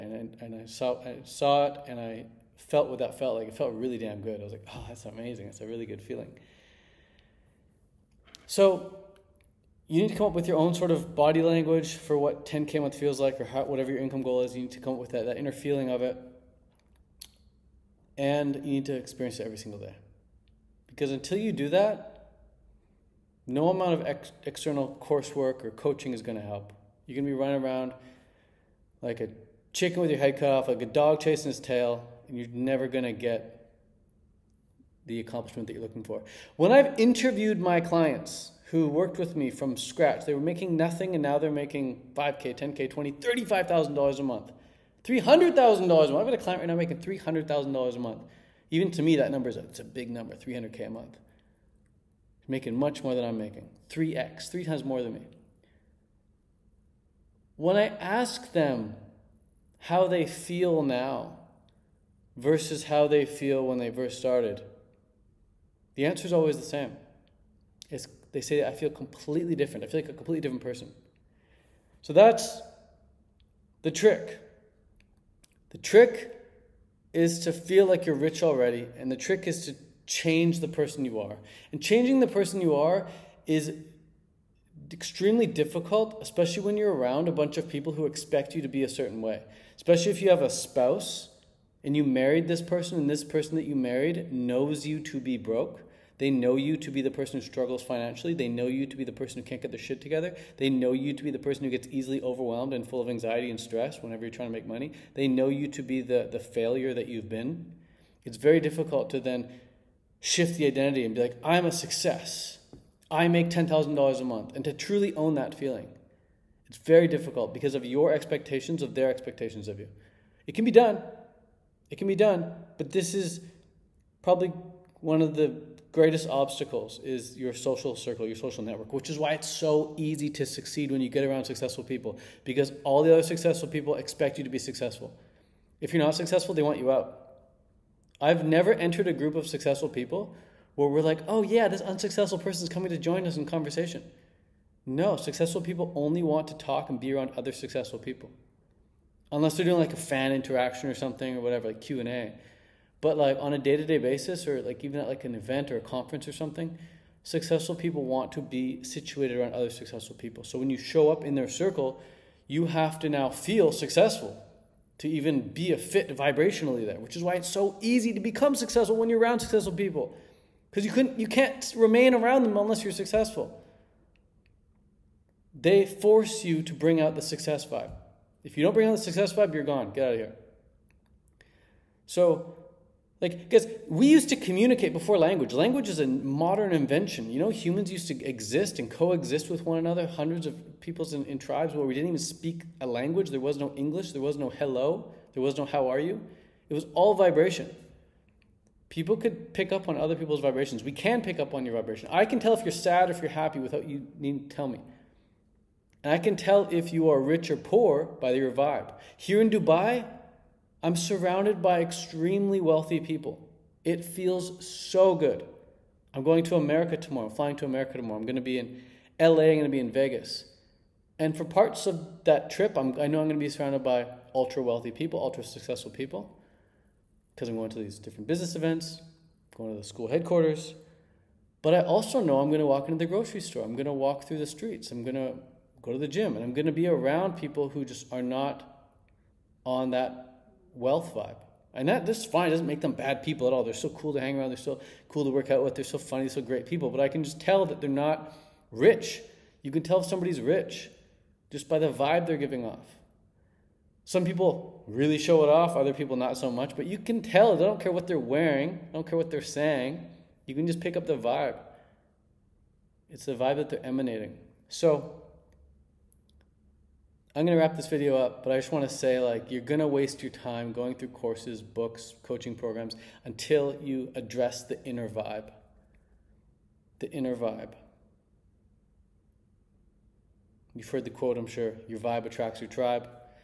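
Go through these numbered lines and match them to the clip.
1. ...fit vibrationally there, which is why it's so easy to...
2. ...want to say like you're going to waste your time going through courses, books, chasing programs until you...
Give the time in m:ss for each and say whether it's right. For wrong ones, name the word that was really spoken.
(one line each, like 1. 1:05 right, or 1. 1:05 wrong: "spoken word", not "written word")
1. 2:45 right
2. 4:28 wrong: "coaching", not "chasing".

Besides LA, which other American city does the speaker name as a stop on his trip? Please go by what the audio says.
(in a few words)
Vegas.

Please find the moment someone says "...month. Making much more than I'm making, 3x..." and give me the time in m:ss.
0:50.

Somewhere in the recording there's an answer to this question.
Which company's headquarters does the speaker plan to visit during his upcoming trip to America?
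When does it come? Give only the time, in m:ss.
3:49.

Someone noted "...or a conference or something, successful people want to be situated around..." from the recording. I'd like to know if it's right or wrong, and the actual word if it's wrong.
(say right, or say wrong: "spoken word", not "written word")
right.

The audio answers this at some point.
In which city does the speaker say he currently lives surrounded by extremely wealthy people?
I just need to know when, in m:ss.
3:29.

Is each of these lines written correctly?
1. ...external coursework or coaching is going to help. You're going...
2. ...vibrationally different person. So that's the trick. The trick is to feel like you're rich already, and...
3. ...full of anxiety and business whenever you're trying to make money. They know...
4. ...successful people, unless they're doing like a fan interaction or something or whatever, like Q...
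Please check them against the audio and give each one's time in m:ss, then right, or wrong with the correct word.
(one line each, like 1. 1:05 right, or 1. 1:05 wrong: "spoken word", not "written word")
1. 0:24 right
2. 1:10 wrong: "completely", not "vibrationally"
3. 1:42 wrong: "stress", not "business"
4. 2:27 right.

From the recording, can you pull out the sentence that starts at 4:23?
It's the vibe that they're emanating.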